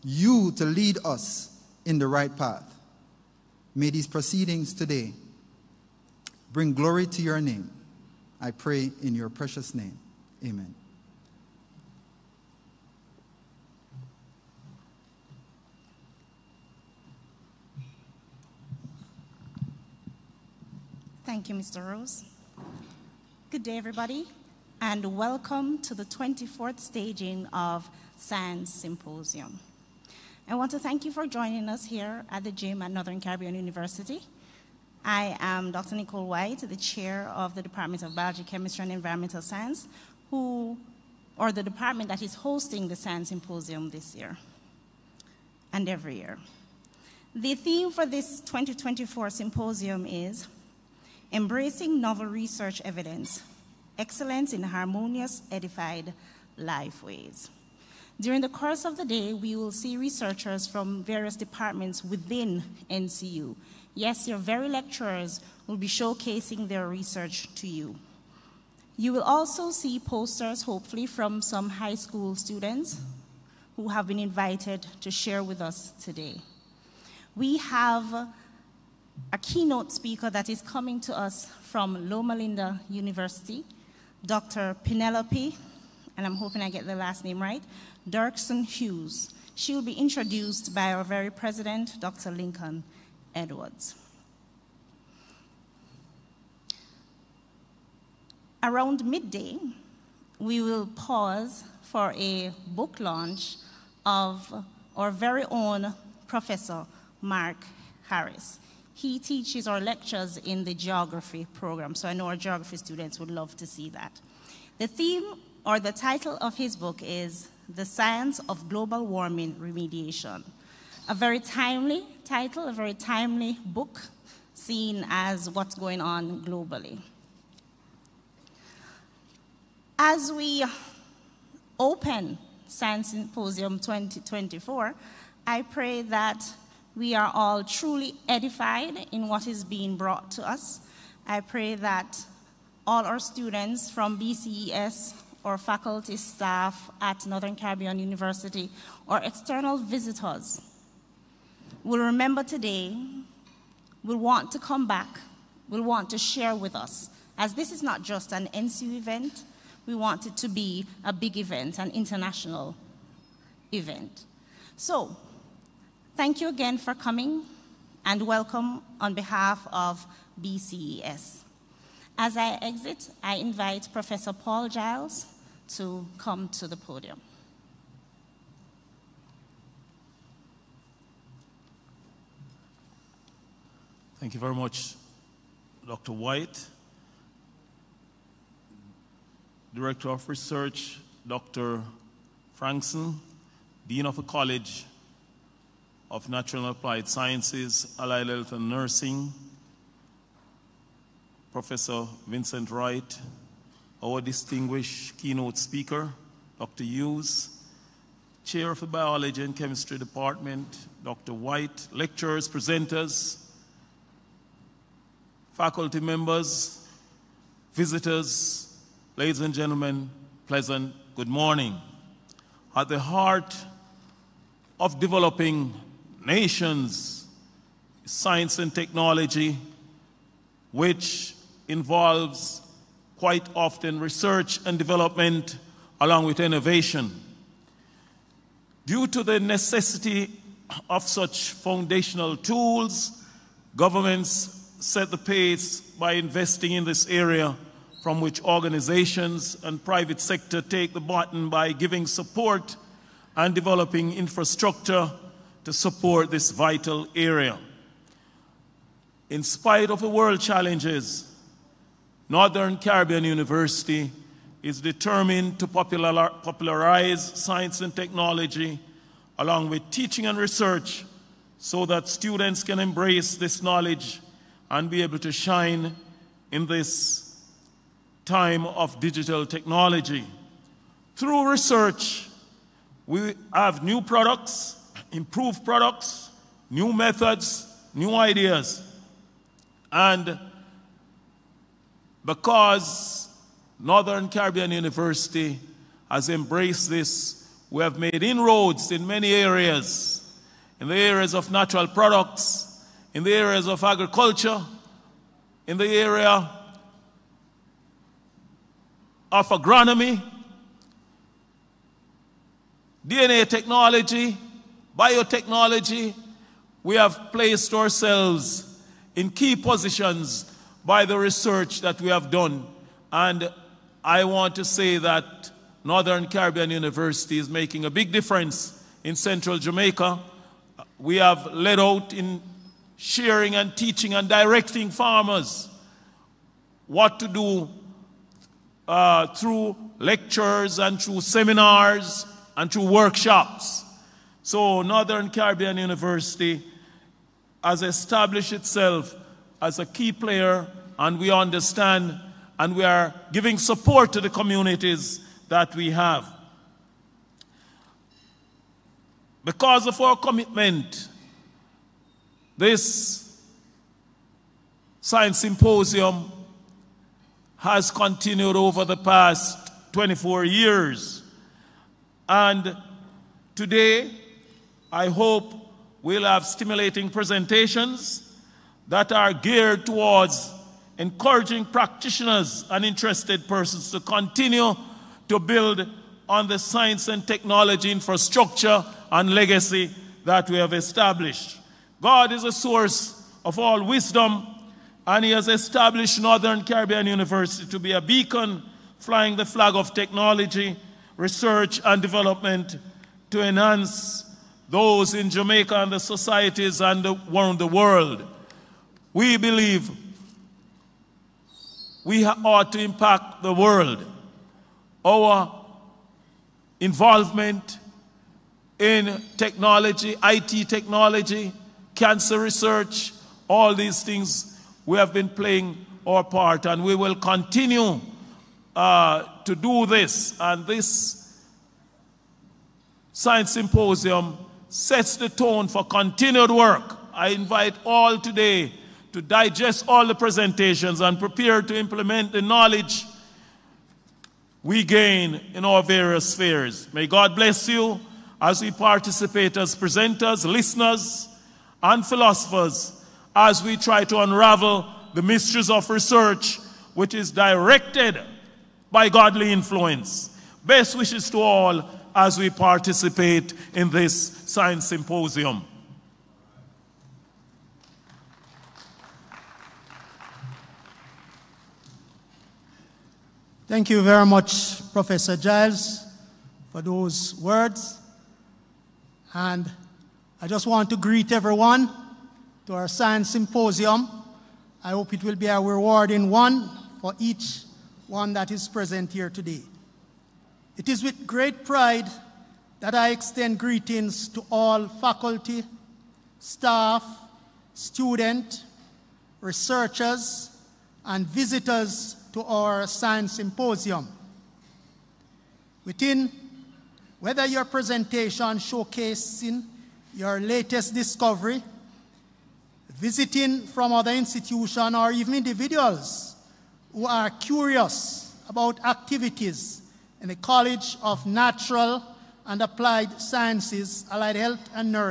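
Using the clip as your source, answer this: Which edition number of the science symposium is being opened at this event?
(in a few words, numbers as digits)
24th.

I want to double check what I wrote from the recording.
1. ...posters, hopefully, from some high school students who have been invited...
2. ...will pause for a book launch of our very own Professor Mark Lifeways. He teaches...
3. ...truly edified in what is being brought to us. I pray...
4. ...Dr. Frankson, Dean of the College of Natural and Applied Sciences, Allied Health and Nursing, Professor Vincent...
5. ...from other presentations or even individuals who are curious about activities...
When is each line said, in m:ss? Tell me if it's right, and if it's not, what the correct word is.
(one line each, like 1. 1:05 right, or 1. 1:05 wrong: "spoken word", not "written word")
1. 1:10 right
2. 1:40 wrong: "Harris", not "Lifeways"
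3. 2:17 right
4. 3:11 right
5. 8:33 wrong: "institutions", not "presentations".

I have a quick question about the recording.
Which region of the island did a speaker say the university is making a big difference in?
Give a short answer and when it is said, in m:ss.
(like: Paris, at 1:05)
Central Jamaica, at 5:29.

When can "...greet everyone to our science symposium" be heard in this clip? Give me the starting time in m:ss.
8:00.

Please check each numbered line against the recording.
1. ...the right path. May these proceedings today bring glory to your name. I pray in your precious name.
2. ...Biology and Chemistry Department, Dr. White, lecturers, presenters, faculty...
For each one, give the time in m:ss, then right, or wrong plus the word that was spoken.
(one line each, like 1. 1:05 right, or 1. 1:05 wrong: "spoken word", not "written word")
1. 0:01 right
2. 3:28 right.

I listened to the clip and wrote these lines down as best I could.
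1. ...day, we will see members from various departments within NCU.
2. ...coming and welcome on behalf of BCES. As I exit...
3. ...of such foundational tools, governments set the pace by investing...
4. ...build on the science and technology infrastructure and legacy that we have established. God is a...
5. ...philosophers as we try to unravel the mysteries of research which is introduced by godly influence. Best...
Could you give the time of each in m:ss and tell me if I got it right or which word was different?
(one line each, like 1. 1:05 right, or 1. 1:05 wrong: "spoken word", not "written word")
1. 0:59 wrong: "researchers", not "members"
2. 2:46 right
3. 4:00 right
4. 6:25 right
5. 7:32 wrong: "directed", not "introduced".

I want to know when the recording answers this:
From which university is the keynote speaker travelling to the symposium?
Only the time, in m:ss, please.
1:22.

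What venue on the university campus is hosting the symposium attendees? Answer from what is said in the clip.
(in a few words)
the gym.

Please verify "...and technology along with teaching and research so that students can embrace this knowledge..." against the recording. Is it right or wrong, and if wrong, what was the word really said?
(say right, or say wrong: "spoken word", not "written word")
right.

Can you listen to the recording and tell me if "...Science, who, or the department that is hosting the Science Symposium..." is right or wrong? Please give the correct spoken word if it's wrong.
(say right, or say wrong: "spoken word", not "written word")
right.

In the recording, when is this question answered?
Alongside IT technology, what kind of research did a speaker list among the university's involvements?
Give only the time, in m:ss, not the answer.
7:01.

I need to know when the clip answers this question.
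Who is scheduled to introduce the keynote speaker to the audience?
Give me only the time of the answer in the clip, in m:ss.
1:31.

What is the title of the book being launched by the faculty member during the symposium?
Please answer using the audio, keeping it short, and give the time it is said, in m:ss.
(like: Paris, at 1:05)
The Science of Global Warming Remediation, at 1:57.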